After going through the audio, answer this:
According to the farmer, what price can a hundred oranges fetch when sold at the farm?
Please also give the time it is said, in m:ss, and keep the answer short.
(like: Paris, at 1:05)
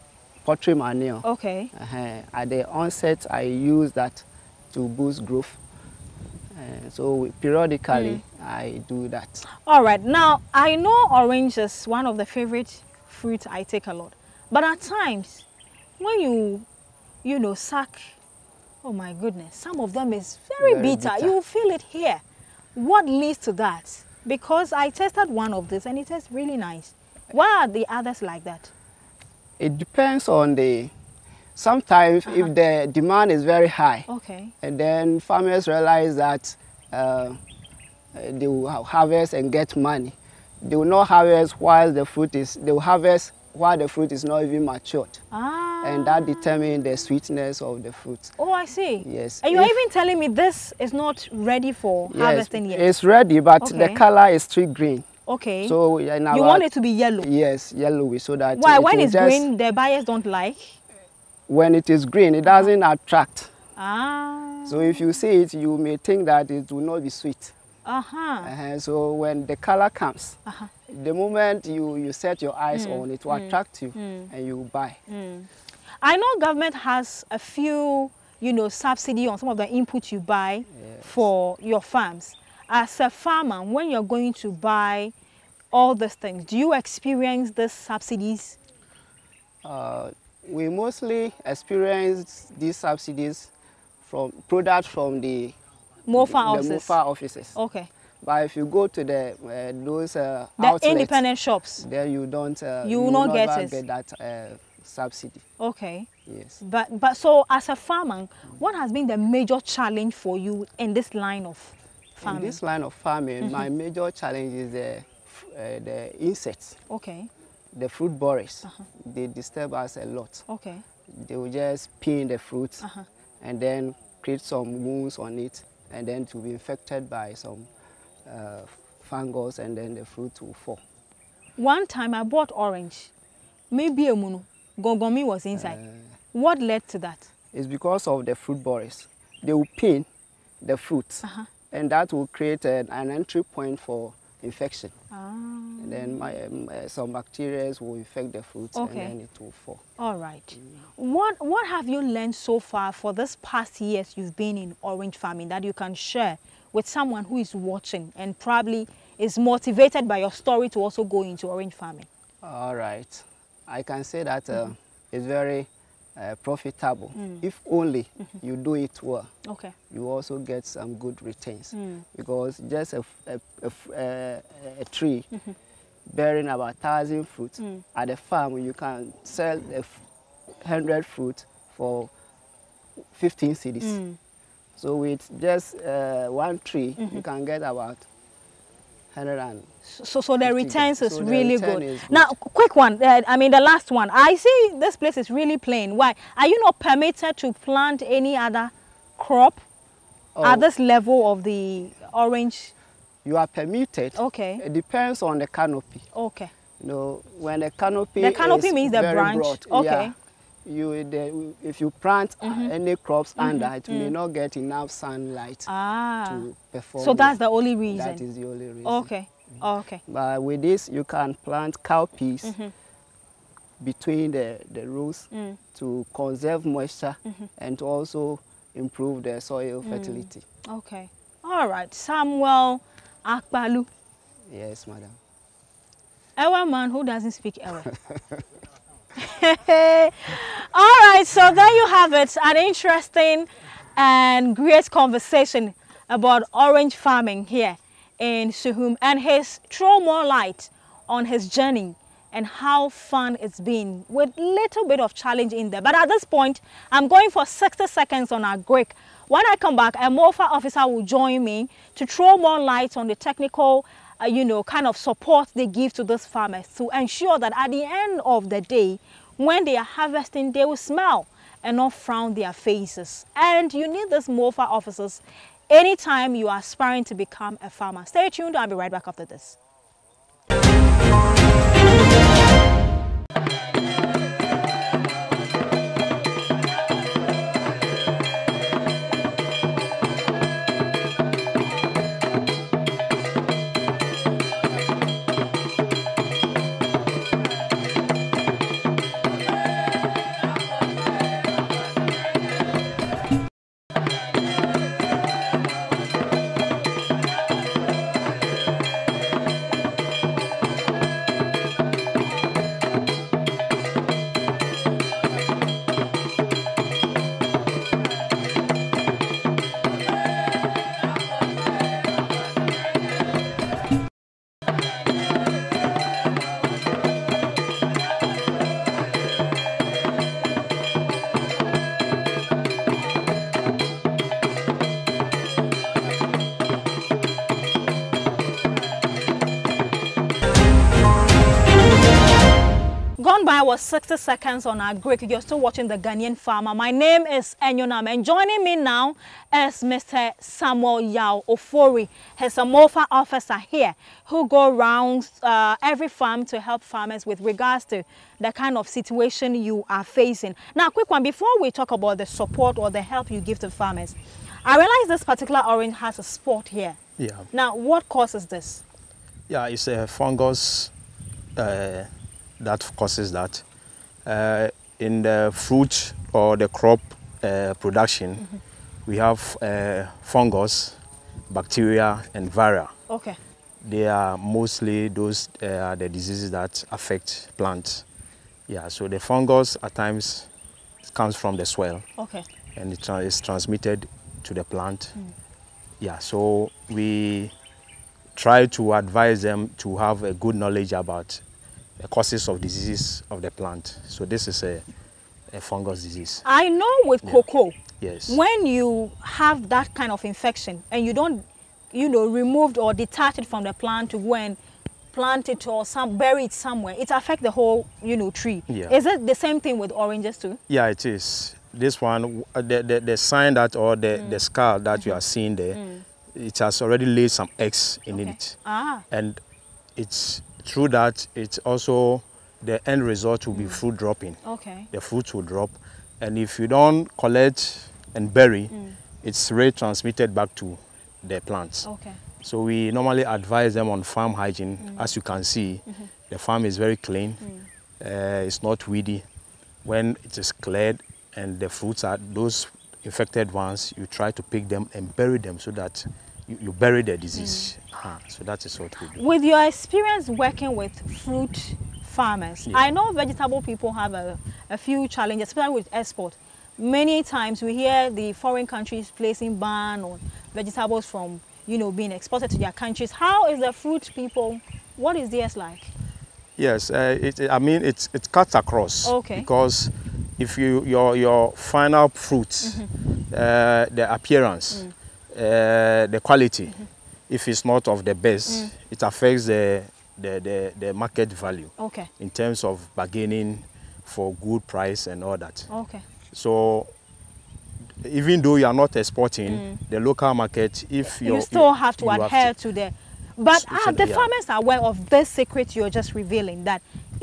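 15 cedis, at 3:03.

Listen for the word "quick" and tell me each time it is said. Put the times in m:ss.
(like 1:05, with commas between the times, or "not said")
3:12, 6:00.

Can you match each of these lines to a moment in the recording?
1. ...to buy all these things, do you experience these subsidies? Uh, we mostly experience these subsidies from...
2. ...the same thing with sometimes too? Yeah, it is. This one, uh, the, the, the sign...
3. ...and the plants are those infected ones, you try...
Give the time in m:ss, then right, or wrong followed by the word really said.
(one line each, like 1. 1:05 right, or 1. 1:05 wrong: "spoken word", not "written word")
1. 1:24 right
2. 6:59 wrong: "oranges", not "sometimes"
3. 7:31 wrong: "fruits", not "plants".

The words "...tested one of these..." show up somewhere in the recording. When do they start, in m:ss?
0:24.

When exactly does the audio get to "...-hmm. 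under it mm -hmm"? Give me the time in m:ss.
3:33.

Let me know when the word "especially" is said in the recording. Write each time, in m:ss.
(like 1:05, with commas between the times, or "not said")
7:45.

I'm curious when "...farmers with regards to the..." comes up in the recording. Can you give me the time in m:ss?
5:56.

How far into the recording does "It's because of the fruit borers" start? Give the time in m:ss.
2:17.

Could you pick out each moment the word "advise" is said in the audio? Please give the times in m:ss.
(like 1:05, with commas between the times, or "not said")
6:38, 7:23.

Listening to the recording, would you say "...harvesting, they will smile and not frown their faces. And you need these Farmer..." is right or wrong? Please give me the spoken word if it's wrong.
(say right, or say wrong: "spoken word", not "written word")
wrong: "MOFA", not "Farmer".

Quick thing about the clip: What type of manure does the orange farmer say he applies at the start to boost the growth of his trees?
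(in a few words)
poultry manure.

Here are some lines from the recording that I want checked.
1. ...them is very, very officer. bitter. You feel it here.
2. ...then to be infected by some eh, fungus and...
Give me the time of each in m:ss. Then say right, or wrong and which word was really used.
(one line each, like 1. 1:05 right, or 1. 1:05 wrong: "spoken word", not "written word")
1. 0:19 wrong: "bitter", not "officer"
2. 2:06 right.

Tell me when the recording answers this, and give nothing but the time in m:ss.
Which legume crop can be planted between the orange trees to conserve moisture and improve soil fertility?
3:41.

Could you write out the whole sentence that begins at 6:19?
we have uh, fungus, bacteria, and viral.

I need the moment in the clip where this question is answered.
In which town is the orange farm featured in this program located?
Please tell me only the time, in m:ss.
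4:08.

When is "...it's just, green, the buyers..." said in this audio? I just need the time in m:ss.
0:58.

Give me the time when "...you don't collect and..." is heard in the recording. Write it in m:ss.
7:16.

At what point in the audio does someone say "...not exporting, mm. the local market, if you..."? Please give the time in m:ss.
8:18.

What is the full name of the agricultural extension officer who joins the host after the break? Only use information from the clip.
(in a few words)
Samuel Yao Ofori.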